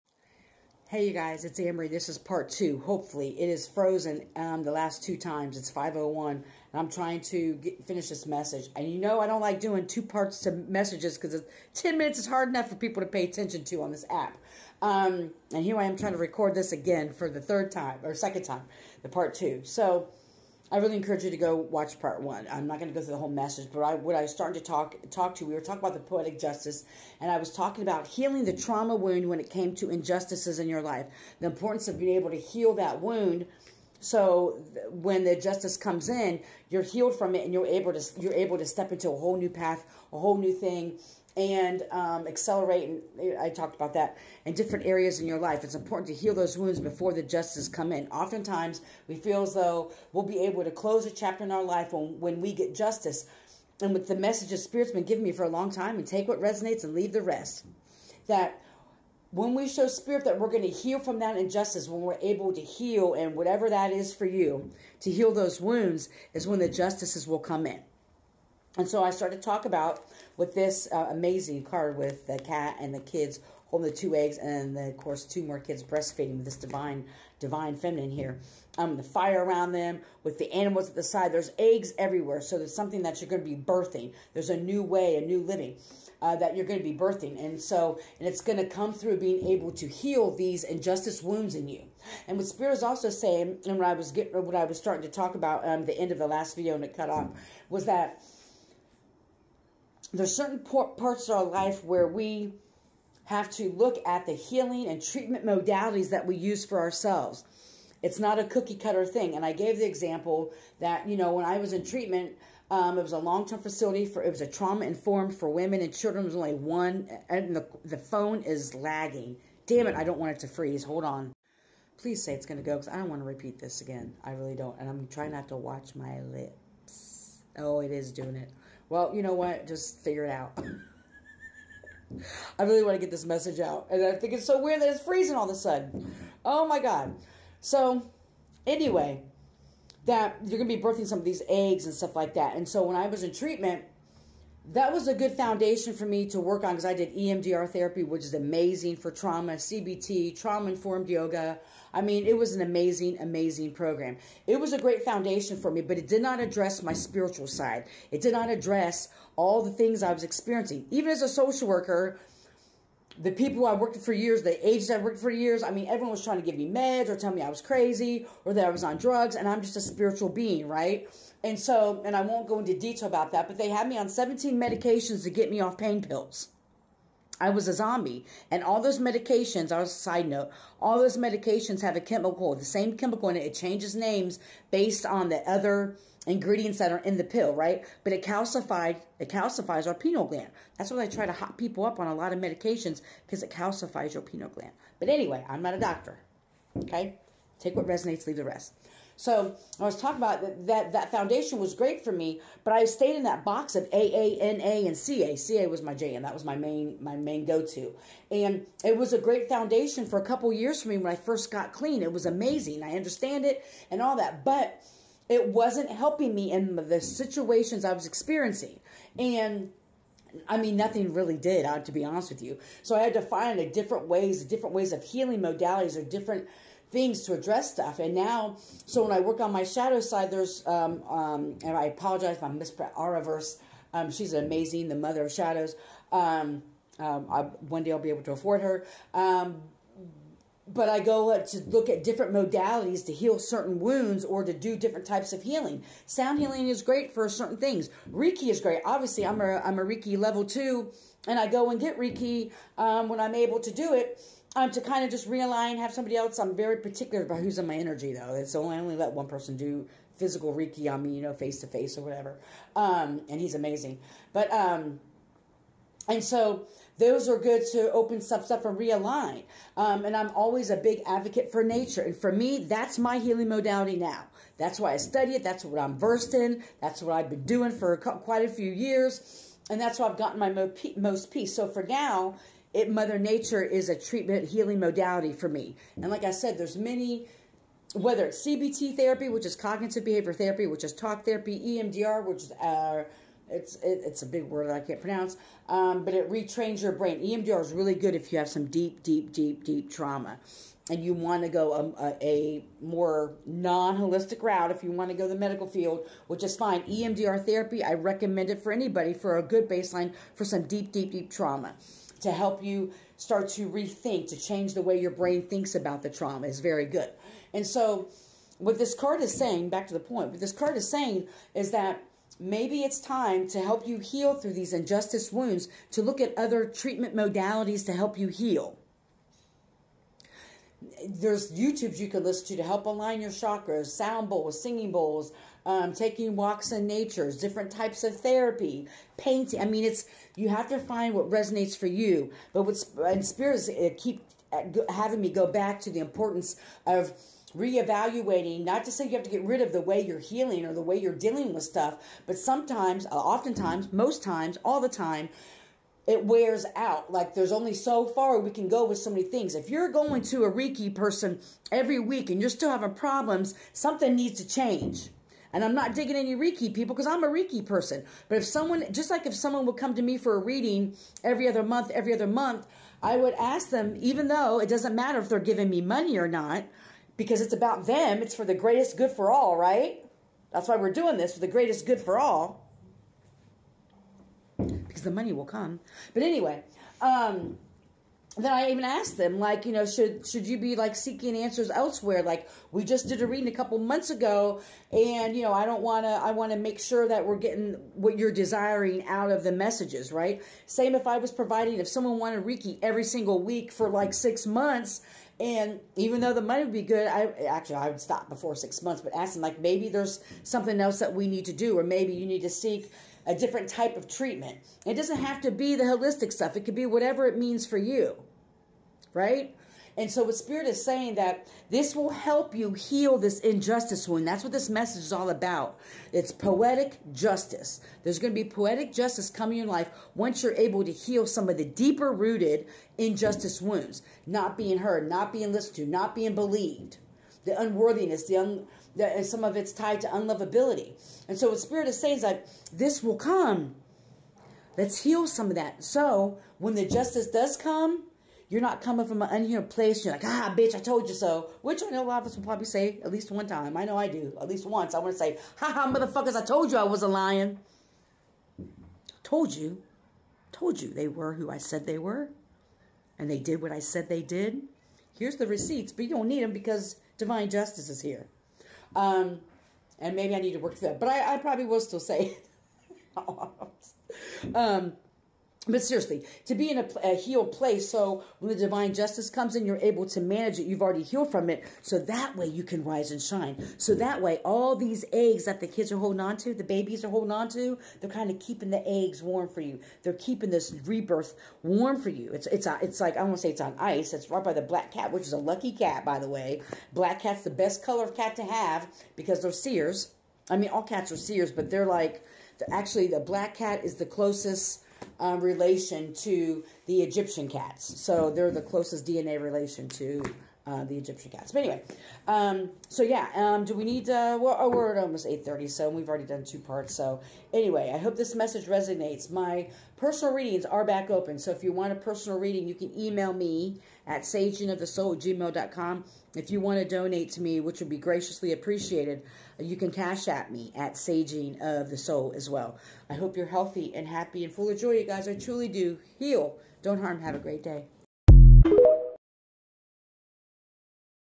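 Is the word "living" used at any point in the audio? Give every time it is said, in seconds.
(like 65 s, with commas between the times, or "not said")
85 s.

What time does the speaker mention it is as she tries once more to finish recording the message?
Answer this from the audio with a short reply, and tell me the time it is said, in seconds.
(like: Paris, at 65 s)
5:01, at 5 s.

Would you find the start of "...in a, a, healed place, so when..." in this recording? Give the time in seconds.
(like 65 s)
476 s.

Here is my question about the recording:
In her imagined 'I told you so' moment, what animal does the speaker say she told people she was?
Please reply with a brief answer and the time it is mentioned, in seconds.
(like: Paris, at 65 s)
a lion, at 457 s.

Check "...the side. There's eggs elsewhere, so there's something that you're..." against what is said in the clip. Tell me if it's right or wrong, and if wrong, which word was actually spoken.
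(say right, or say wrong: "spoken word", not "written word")
wrong: "everywhere", not "elsewhere".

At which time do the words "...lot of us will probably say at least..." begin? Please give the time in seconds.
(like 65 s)
452 s.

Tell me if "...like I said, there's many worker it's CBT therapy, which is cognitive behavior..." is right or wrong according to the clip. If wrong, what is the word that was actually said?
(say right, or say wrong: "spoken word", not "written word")
wrong: "whether", not "worker".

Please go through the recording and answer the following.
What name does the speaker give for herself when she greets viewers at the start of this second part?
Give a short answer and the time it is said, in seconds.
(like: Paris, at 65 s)
AnnMarie, at 1 s.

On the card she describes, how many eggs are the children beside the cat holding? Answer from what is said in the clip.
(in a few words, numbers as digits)
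2.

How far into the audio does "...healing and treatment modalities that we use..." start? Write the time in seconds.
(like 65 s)
104 s.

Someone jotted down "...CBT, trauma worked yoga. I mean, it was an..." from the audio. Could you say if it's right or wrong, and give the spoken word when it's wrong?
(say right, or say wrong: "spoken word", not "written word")
wrong: "informed", not "worked".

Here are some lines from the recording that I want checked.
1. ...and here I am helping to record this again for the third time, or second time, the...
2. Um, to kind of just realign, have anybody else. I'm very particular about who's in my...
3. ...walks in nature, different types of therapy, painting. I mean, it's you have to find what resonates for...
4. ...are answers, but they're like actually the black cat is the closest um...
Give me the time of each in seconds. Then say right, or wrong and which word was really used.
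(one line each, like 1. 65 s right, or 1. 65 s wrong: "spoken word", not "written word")
1. 15 s wrong: "trying", not "helping"
2. 254 s wrong: "somebody", not "anybody"
3. 336 s right
4. 501 s wrong: "seers", not "answers".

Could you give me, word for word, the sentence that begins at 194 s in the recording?
But anyway, I'm not a doctor.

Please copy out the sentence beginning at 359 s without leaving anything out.
If you're going to a Reiki person every week and you're still having problems, something needs to change.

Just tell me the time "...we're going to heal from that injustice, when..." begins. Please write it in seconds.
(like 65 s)
60 s.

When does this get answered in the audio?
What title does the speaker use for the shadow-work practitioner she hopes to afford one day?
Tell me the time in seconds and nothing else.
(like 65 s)
234 s.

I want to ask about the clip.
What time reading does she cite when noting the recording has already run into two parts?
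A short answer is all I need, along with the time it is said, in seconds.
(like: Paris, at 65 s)
8:30, at 515 s.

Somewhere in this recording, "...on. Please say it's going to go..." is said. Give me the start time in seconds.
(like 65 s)
121 s.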